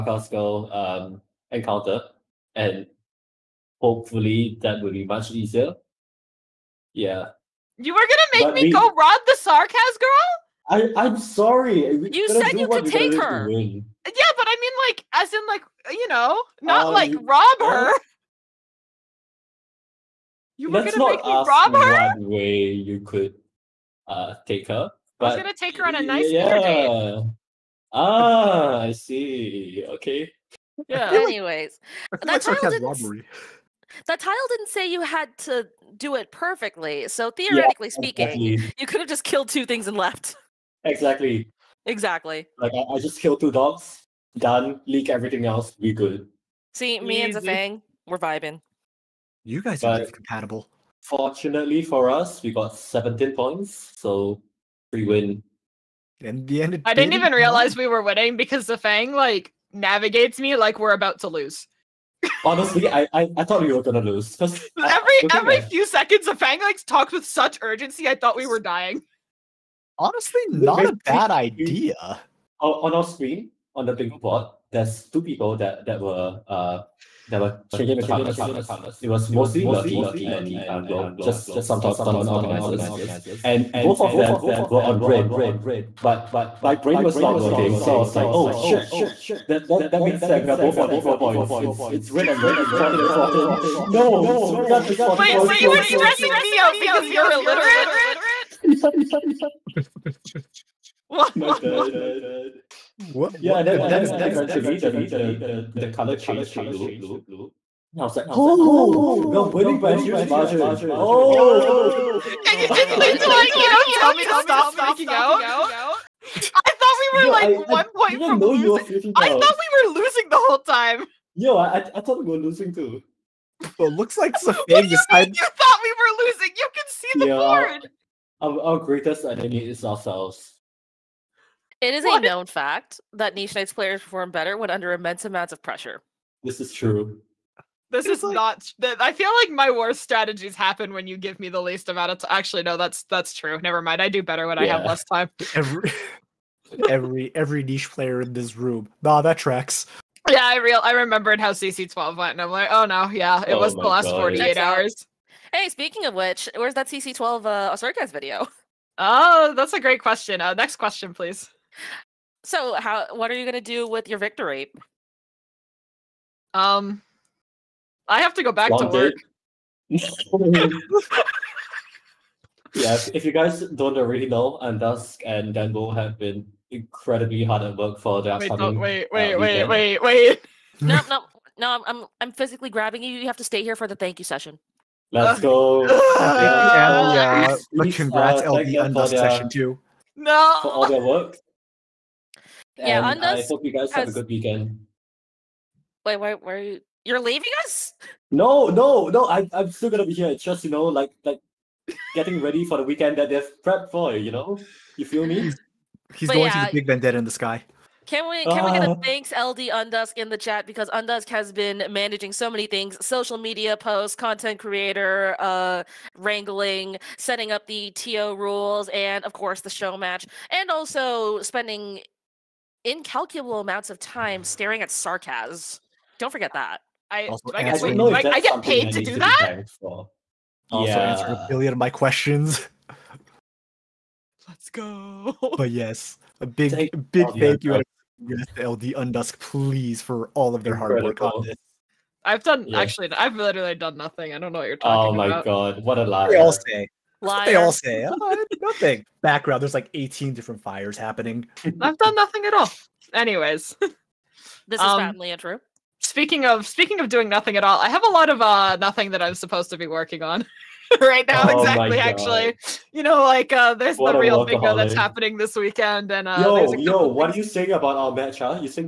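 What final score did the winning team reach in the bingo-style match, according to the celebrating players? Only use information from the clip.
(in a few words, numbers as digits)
17.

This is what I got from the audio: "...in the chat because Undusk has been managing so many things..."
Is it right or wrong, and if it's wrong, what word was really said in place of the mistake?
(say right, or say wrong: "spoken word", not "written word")
right.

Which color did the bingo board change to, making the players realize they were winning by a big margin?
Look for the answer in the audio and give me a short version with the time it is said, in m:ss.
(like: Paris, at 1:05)
blue, at 1:46.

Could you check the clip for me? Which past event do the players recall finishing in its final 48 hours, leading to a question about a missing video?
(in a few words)
CC12.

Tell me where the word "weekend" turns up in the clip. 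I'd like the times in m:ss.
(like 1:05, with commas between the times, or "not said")
3:14, 3:22, 4:25.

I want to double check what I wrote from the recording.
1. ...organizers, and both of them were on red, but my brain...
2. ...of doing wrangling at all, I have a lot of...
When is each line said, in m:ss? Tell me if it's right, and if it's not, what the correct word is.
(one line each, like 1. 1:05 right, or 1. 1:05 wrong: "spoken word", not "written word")
1. 1:22 right
2. 4:16 wrong: "nothing", not "wrangling".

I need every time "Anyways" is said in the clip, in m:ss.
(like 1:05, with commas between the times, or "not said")
0:31, 4:13.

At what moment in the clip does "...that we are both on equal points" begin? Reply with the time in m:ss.
1:30.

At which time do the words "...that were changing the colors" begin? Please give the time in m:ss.
1:17.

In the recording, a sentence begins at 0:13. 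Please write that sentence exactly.
Yeah, but I mean like as in like you know, not um, like rob her.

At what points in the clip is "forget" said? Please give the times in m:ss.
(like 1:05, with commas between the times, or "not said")
3:46.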